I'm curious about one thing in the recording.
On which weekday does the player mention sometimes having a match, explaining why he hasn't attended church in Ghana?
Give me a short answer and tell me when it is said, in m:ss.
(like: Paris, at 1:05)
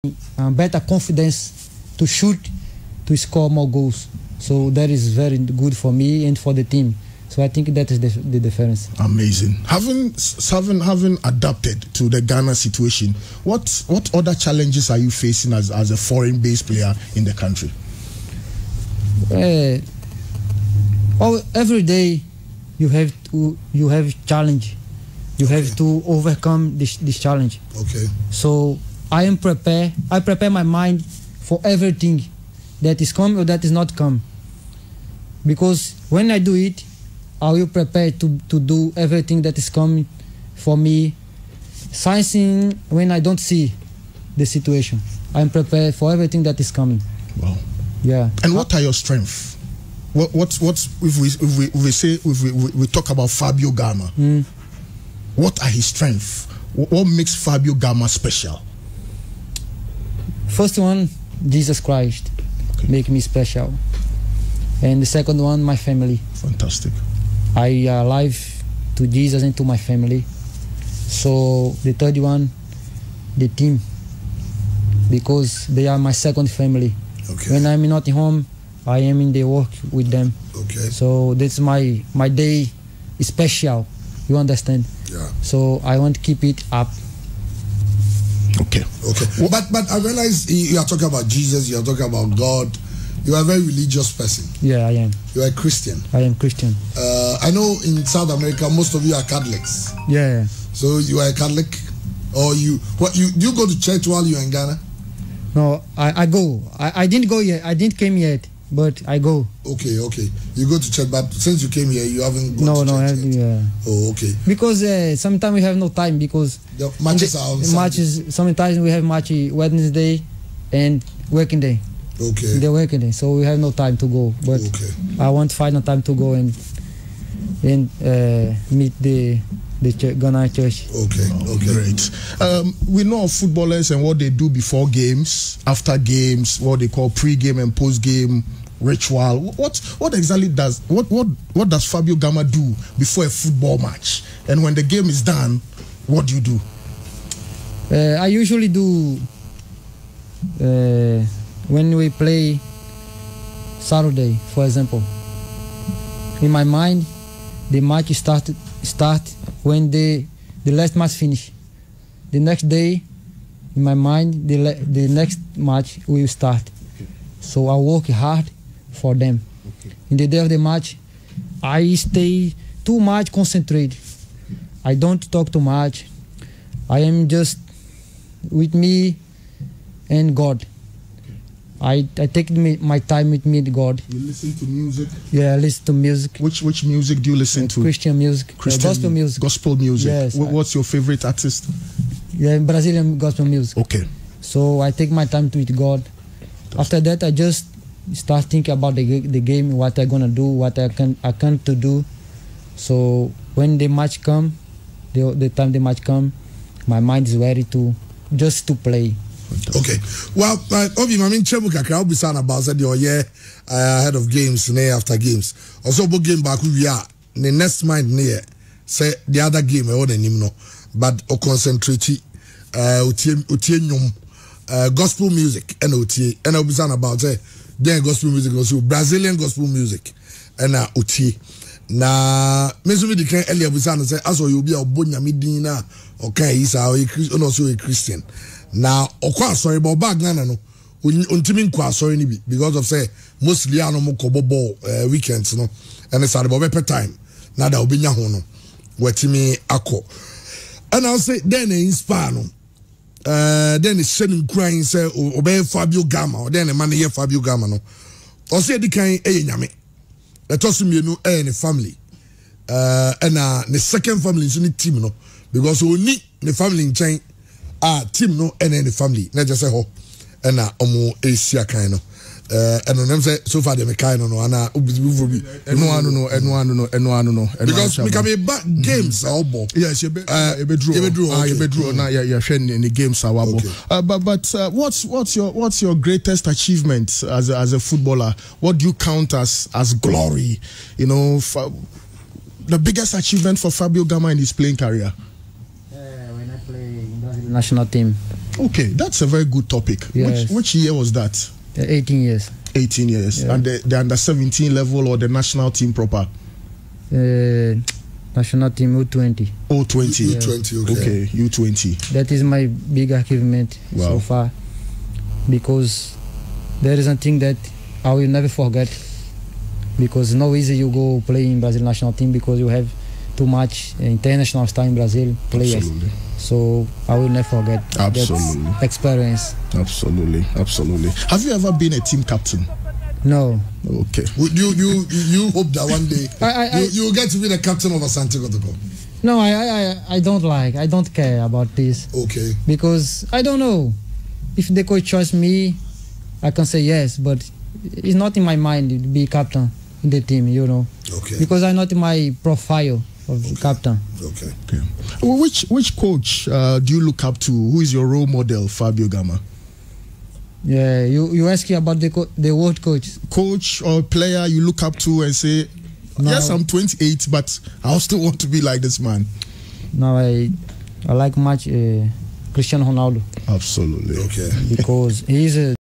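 Wednesday, at 1:59.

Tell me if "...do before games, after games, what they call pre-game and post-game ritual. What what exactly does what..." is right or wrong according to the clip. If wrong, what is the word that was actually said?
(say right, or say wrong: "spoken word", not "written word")
right.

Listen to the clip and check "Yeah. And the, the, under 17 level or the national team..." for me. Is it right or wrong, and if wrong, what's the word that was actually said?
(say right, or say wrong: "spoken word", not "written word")
right.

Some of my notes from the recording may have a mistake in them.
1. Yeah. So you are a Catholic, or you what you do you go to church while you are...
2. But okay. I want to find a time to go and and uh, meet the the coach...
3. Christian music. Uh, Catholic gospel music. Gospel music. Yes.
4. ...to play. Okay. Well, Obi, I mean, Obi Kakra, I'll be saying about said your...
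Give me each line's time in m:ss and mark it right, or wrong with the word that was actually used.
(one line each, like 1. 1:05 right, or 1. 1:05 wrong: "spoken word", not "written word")
1. 1:40 right
2. 2:04 wrong: "church", not "coach"
3. 3:07 wrong: "Christian", not "Catholic"
4. 3:28 wrong: "Chemu", not "Obi".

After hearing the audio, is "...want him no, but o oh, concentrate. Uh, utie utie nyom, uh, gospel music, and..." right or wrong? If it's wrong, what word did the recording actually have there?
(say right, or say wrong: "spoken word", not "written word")
right.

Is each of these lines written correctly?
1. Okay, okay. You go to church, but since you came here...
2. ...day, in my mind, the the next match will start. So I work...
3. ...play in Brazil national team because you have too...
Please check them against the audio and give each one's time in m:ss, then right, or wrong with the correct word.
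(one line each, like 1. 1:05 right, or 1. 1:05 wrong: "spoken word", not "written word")
1. 1:49 right
2. 2:42 right
3. 5:21 right.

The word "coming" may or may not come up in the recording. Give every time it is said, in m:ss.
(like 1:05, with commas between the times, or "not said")
0:39, 0:46.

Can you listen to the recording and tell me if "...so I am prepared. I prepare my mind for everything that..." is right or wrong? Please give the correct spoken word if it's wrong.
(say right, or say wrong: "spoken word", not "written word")
right.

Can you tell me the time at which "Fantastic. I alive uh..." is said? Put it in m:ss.
1:06.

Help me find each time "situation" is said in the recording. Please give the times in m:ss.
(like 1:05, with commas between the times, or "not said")
0:12, 0:44.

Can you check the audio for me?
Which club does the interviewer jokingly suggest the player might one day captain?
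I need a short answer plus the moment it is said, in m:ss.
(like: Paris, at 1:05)
Asante Kotoko, at 5:38.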